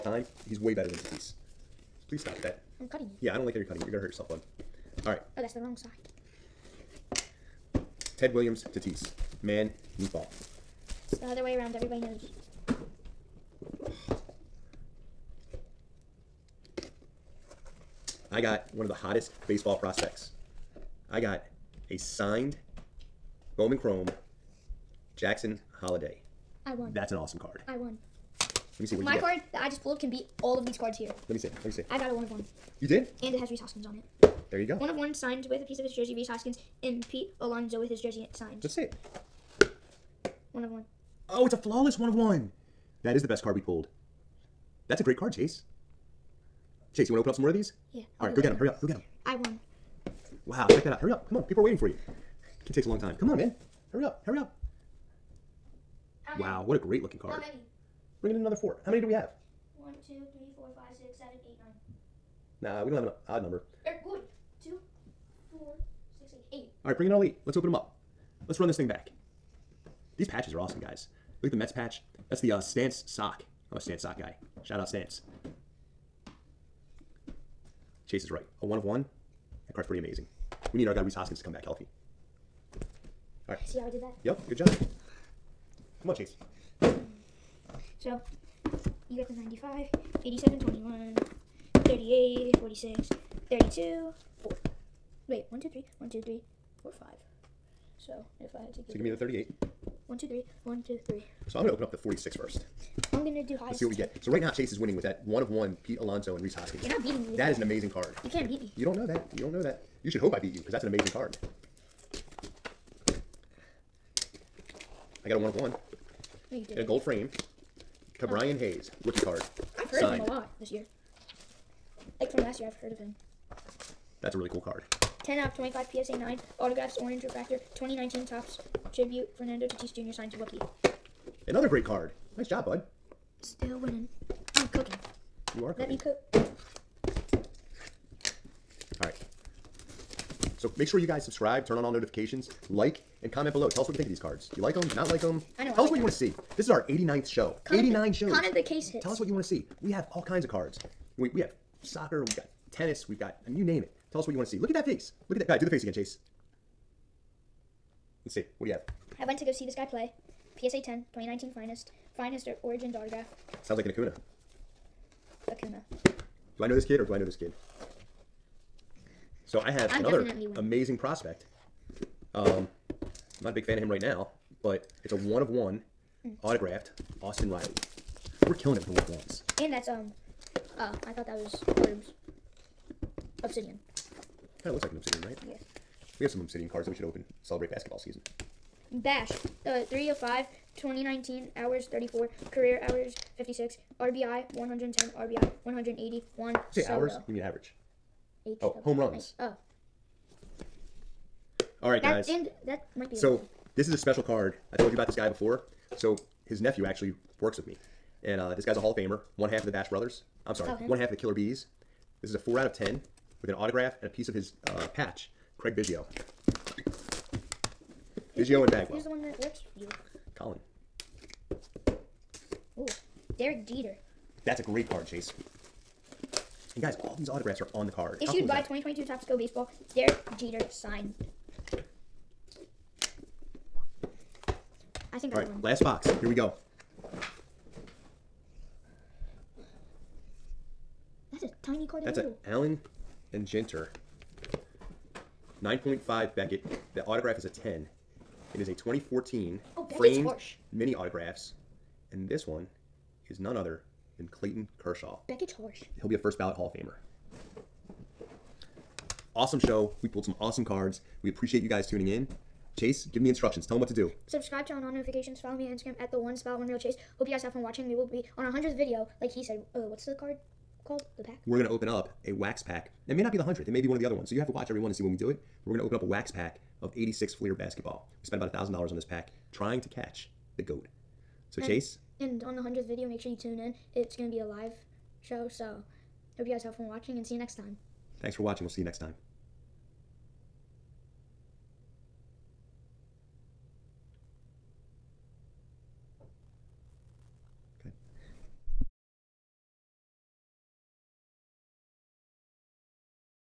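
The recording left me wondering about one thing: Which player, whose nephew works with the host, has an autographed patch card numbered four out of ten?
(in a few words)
Craig Biggio.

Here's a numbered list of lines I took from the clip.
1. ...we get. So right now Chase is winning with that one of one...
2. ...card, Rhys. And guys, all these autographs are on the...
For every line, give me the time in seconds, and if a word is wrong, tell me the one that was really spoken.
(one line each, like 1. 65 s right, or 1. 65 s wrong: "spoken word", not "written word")
1. 103 s right
2. 224 s wrong: "Chase", not "Rhys".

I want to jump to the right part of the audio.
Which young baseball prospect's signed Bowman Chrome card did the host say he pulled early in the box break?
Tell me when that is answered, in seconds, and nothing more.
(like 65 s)
25 s.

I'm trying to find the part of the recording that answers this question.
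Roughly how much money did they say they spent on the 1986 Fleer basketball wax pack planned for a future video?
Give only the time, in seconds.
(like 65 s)
278 s.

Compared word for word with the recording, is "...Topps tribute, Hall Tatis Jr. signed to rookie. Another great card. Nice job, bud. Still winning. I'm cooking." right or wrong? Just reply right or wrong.
wrong.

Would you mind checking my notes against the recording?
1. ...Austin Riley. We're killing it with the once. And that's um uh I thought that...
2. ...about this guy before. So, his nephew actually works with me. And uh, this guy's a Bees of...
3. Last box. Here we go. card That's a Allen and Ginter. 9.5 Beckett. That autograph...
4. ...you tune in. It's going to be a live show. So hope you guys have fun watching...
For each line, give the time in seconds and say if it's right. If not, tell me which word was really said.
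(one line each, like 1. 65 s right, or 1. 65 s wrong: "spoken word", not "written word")
1. 177 s right
2. 204 s wrong: "Hall", not "Bees"
3. 235 s right
4. 283 s right.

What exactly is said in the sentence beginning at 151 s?
We, we have soccer, we've got tennis, we've got, I mean, you name it.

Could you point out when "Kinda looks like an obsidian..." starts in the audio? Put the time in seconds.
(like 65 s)
184 s.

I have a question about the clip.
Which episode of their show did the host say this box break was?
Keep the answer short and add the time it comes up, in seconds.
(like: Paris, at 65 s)
89th, at 146 s.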